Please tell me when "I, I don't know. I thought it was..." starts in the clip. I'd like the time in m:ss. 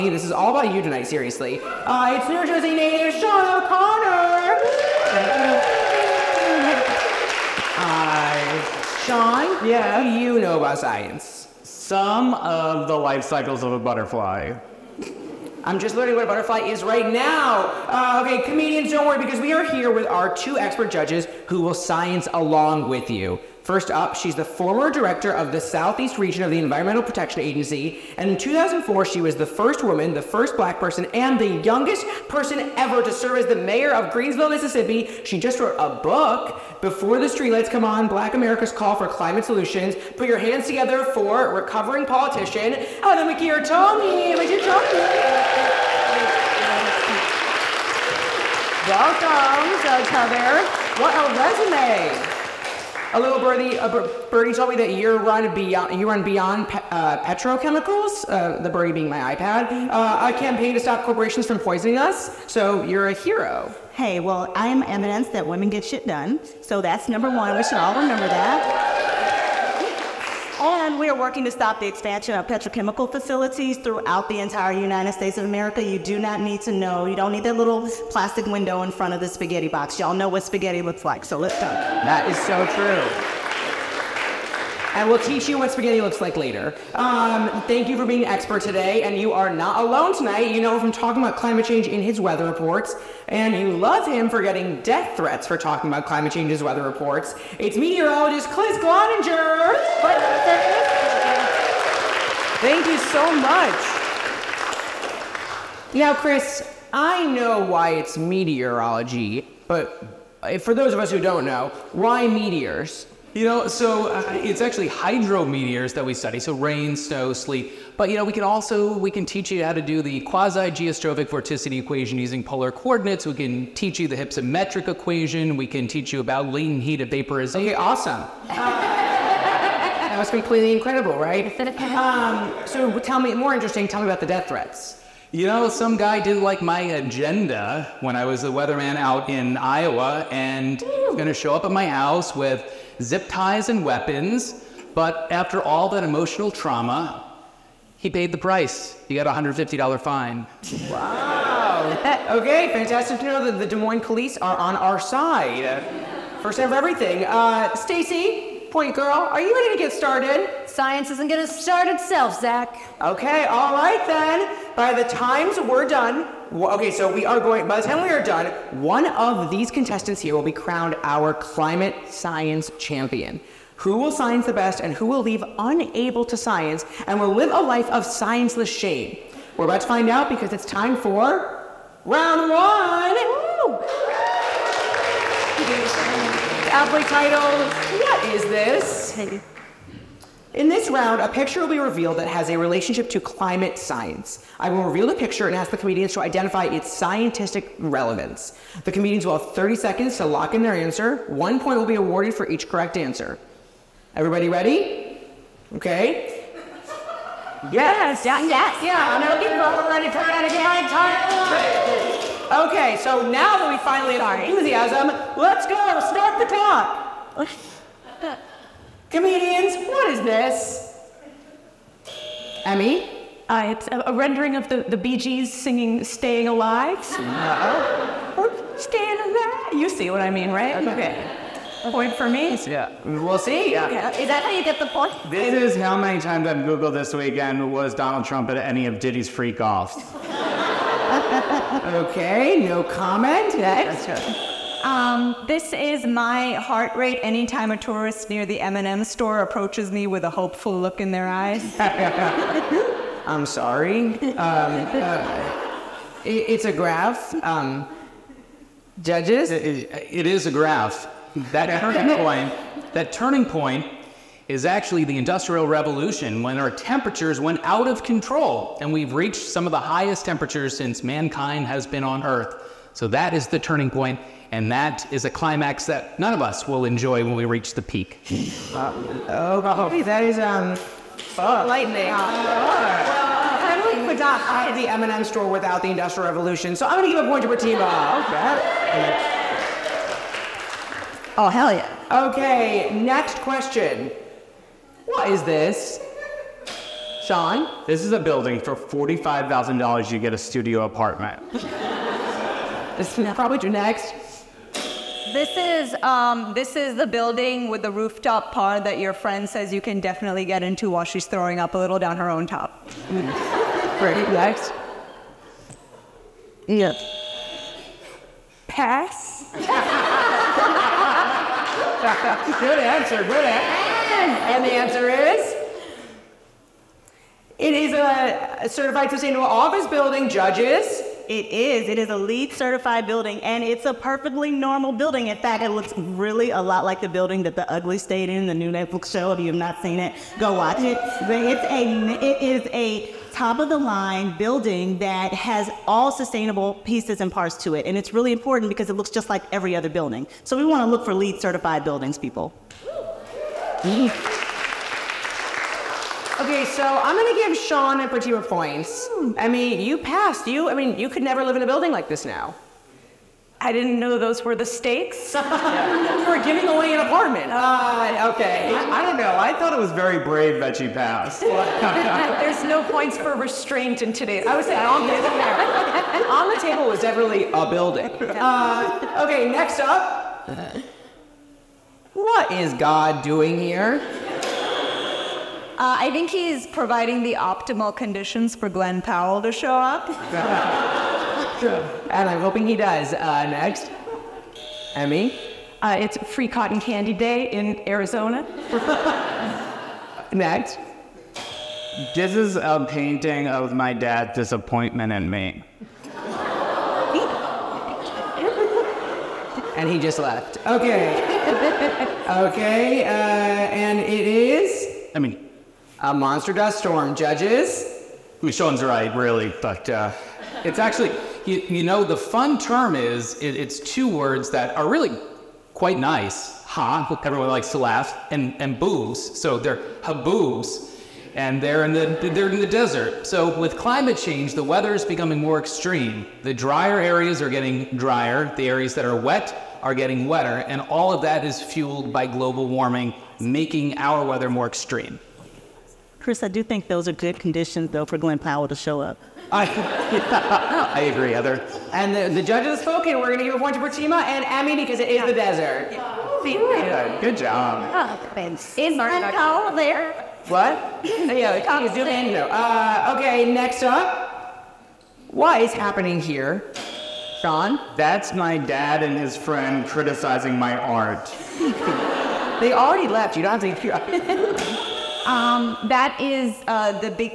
6:08.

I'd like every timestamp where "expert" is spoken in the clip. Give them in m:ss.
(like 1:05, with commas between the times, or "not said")
0:20, 1:28.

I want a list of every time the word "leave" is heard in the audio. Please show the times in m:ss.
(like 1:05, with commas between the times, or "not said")
2:55.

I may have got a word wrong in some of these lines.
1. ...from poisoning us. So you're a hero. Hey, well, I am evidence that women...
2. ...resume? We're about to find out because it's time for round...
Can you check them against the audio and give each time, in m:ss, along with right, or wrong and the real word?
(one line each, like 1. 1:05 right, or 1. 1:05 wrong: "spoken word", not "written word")
1. 1:01 right
2. 2:58 wrong: "shame", not "resume".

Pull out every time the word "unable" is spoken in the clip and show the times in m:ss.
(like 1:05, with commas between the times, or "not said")
2:55.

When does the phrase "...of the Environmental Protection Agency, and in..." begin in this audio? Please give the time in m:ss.
0:26.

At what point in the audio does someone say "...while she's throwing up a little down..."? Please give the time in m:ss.
5:10.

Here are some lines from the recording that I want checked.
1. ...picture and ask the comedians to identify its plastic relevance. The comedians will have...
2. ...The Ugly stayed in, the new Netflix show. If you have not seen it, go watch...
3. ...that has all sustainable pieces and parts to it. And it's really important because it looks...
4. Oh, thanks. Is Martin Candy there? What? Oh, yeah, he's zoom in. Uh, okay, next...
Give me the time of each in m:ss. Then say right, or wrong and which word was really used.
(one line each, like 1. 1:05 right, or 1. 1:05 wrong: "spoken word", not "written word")
1. 3:15 wrong: "scientific", not "plastic"
2. 5:37 right
3. 5:44 right
4. 7:37 wrong: "Powell", not "Candy".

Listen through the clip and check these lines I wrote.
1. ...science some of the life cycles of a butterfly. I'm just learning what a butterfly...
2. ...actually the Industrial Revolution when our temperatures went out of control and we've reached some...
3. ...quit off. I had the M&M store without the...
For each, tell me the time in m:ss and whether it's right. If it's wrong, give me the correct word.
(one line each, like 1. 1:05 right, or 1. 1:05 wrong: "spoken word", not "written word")
1. 0:10 right
2. 4:24 right
3. 4:44 right.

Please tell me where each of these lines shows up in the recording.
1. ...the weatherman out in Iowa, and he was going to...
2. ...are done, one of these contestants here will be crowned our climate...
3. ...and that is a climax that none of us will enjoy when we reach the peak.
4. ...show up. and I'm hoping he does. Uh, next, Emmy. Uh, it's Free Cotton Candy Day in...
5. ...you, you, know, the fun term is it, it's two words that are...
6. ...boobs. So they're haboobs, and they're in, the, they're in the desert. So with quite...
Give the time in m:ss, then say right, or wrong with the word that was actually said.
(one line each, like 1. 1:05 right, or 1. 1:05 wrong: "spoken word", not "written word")
1. 2:18 right
2. 2:48 right
3. 4:34 right
4. 6:29 right
5. 7:01 right
6. 7:08 wrong: "climate", not "quite".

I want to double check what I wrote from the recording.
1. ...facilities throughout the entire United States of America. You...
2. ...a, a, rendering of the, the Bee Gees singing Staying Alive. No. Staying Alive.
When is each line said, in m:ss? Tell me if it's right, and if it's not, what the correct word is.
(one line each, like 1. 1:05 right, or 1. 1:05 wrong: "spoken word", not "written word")
1. 1:13 right
2. 3:43 right.